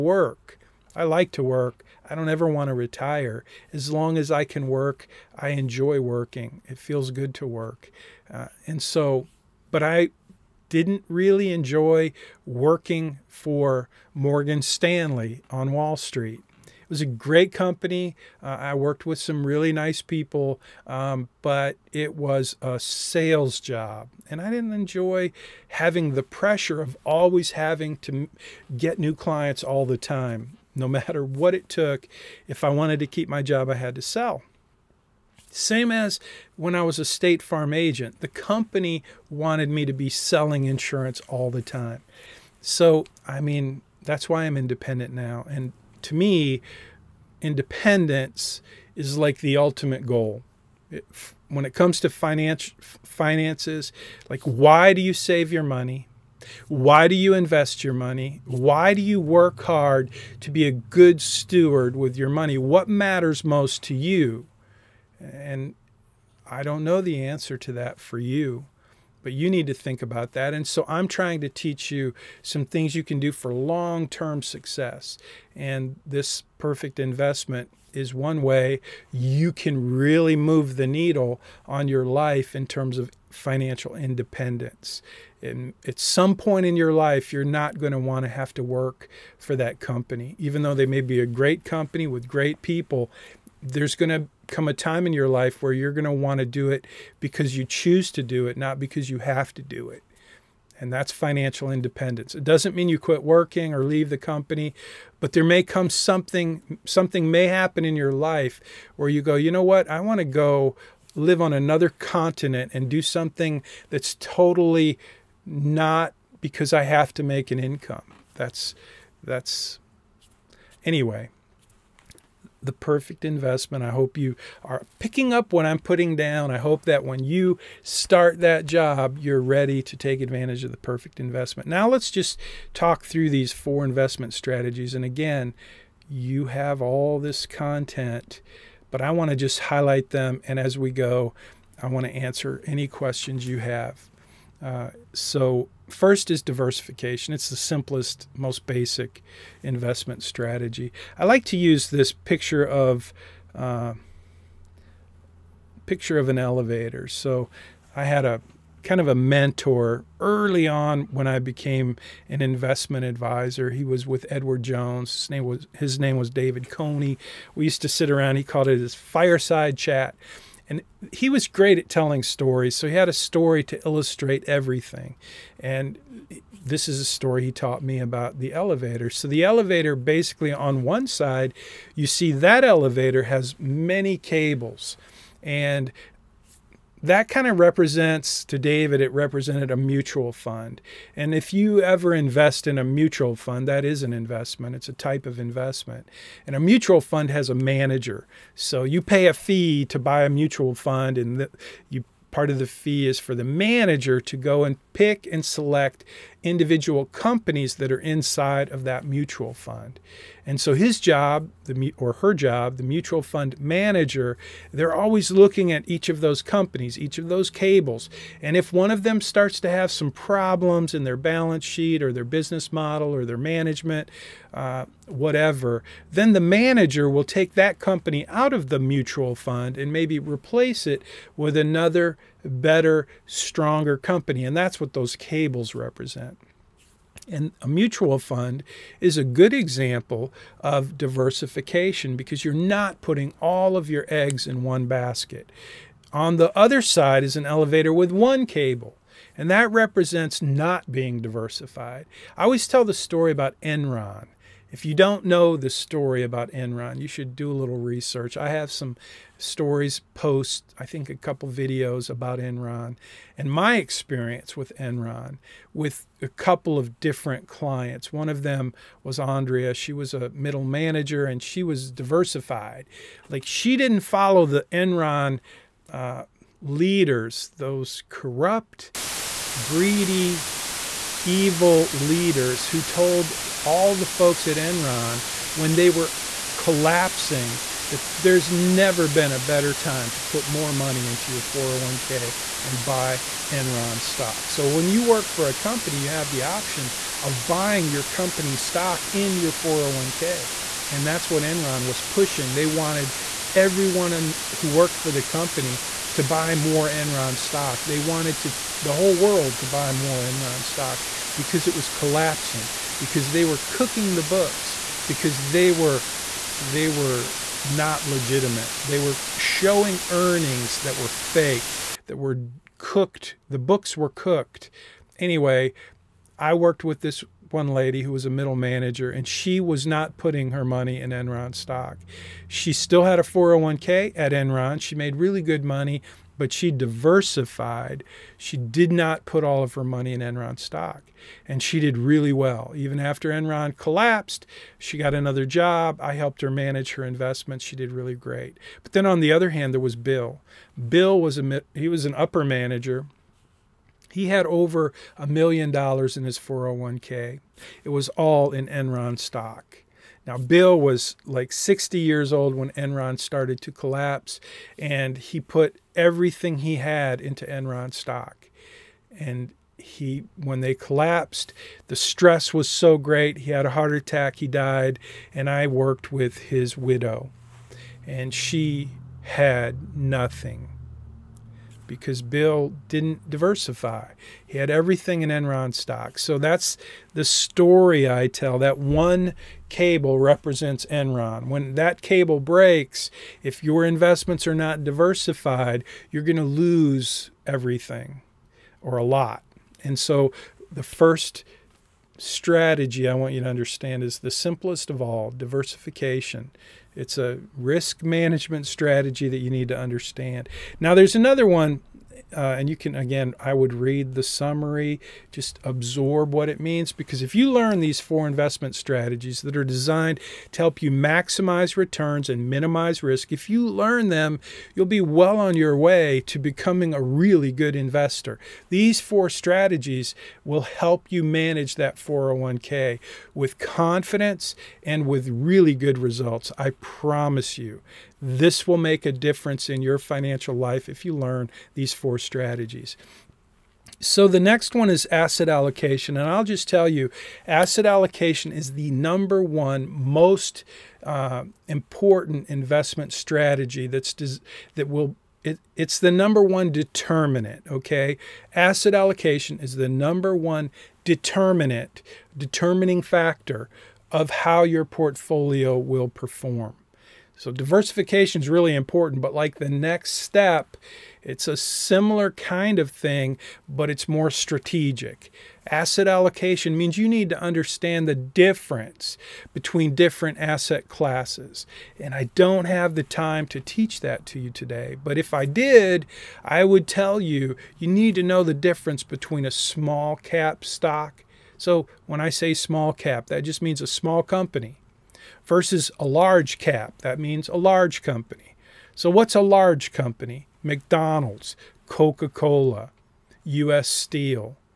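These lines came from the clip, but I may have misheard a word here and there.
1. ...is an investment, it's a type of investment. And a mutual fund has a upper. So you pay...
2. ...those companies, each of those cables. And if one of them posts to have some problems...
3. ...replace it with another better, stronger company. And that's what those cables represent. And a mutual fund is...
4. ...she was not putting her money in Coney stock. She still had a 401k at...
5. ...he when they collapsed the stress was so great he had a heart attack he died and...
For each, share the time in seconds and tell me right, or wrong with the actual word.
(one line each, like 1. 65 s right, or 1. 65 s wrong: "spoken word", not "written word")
1. 193 s wrong: "manager", not "upper"
2. 216 s wrong: "starts", not "posts"
3. 230 s right
4. 329 s wrong: "Enron", not "Coney"
5. 369 s right.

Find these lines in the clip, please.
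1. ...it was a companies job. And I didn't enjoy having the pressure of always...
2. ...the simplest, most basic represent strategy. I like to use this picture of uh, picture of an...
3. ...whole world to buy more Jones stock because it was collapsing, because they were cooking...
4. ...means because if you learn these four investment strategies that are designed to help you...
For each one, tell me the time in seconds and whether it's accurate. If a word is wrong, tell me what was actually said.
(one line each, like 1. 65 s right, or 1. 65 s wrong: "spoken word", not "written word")
1. 21 s wrong: "sales", not "companies"
2. 147 s wrong: "investment", not "represent"
3. 308 s wrong: "Enron", not "Jones"
4. 416 s right.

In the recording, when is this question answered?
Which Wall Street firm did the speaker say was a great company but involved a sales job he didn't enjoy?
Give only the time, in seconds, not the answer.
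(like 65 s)
14 s.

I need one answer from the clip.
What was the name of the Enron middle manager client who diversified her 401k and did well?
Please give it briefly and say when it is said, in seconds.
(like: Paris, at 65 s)
Andrea, at 269 s.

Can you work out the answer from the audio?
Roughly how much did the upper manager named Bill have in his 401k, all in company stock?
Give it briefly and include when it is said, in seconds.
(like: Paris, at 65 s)
Over $1,000,000, at 354 s.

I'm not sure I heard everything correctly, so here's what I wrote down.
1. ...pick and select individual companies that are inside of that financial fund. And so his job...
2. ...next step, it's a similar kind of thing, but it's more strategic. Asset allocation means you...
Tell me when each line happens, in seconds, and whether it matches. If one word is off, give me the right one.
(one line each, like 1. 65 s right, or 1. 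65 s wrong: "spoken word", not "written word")
1. 204 s wrong: "mutual", not "financial"
2. 469 s right.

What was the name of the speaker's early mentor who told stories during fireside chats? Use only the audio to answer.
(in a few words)
David Coney.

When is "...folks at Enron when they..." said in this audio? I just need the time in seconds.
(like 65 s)
284 s.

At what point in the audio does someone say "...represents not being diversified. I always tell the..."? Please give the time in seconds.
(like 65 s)
249 s.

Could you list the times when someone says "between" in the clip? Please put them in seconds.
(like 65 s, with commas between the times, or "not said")
479 s, 489 s.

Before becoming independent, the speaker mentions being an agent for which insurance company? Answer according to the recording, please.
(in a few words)
State Farm.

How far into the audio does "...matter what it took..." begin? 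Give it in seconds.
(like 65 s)
30 s.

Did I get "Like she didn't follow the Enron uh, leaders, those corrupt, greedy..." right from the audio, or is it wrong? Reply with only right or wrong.
right.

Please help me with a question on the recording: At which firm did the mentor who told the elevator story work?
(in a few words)
Edward Jones.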